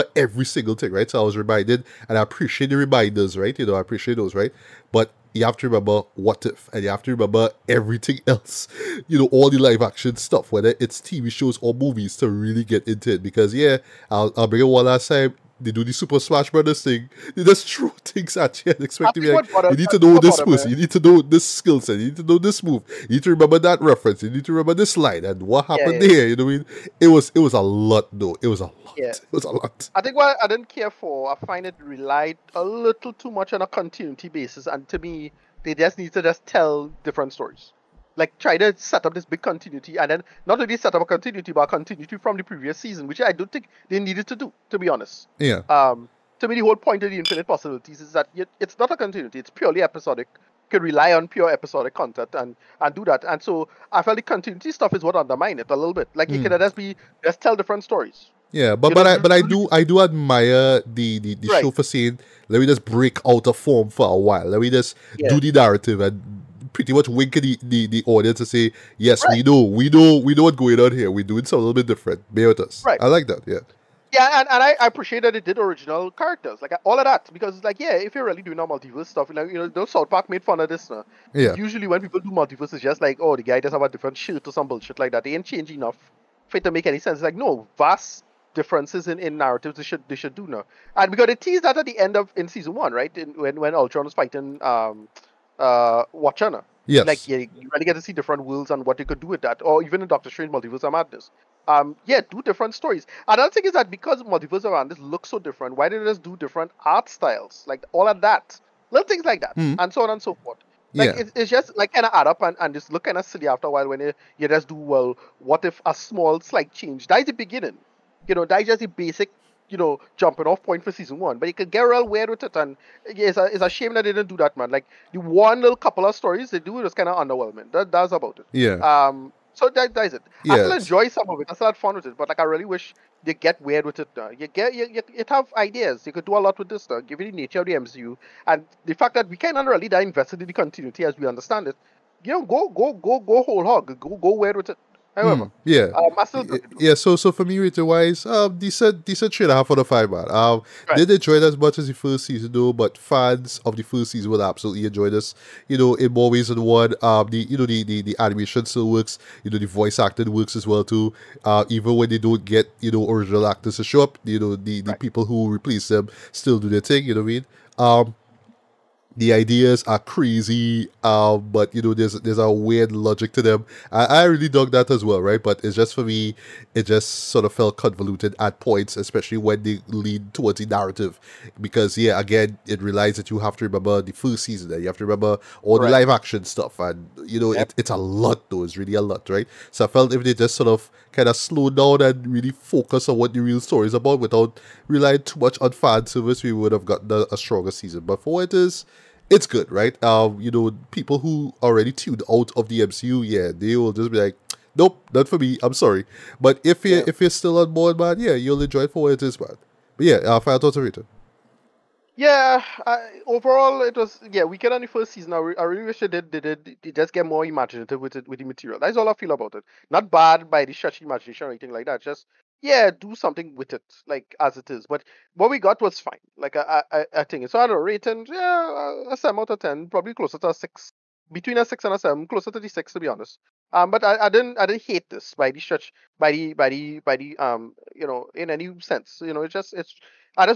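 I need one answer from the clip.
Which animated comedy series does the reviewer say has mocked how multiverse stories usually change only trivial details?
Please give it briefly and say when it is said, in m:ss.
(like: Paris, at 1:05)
South Park, at 1:19.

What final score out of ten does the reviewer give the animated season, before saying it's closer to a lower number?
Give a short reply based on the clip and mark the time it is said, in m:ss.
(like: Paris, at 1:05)
7, at 3:49.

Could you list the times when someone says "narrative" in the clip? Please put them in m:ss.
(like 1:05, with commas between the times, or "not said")
1:05, 1:29, 3:00.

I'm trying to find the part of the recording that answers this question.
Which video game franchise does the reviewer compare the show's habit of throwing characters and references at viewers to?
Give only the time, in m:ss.
0:15.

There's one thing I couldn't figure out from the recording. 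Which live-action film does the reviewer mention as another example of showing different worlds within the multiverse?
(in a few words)
Doctor Strange Multiverse of Madness.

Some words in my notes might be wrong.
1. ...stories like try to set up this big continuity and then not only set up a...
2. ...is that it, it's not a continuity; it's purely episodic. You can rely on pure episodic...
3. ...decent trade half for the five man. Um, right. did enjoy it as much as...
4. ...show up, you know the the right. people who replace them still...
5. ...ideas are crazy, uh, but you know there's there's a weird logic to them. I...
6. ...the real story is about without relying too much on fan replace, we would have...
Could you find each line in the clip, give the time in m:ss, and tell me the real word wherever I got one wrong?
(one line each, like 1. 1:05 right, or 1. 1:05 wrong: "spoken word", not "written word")
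1. 0:37 right
2. 0:48 right
3. 2:29 right
4. 2:43 right
5. 2:49 right
6. 3:13 wrong: "service", not "replace".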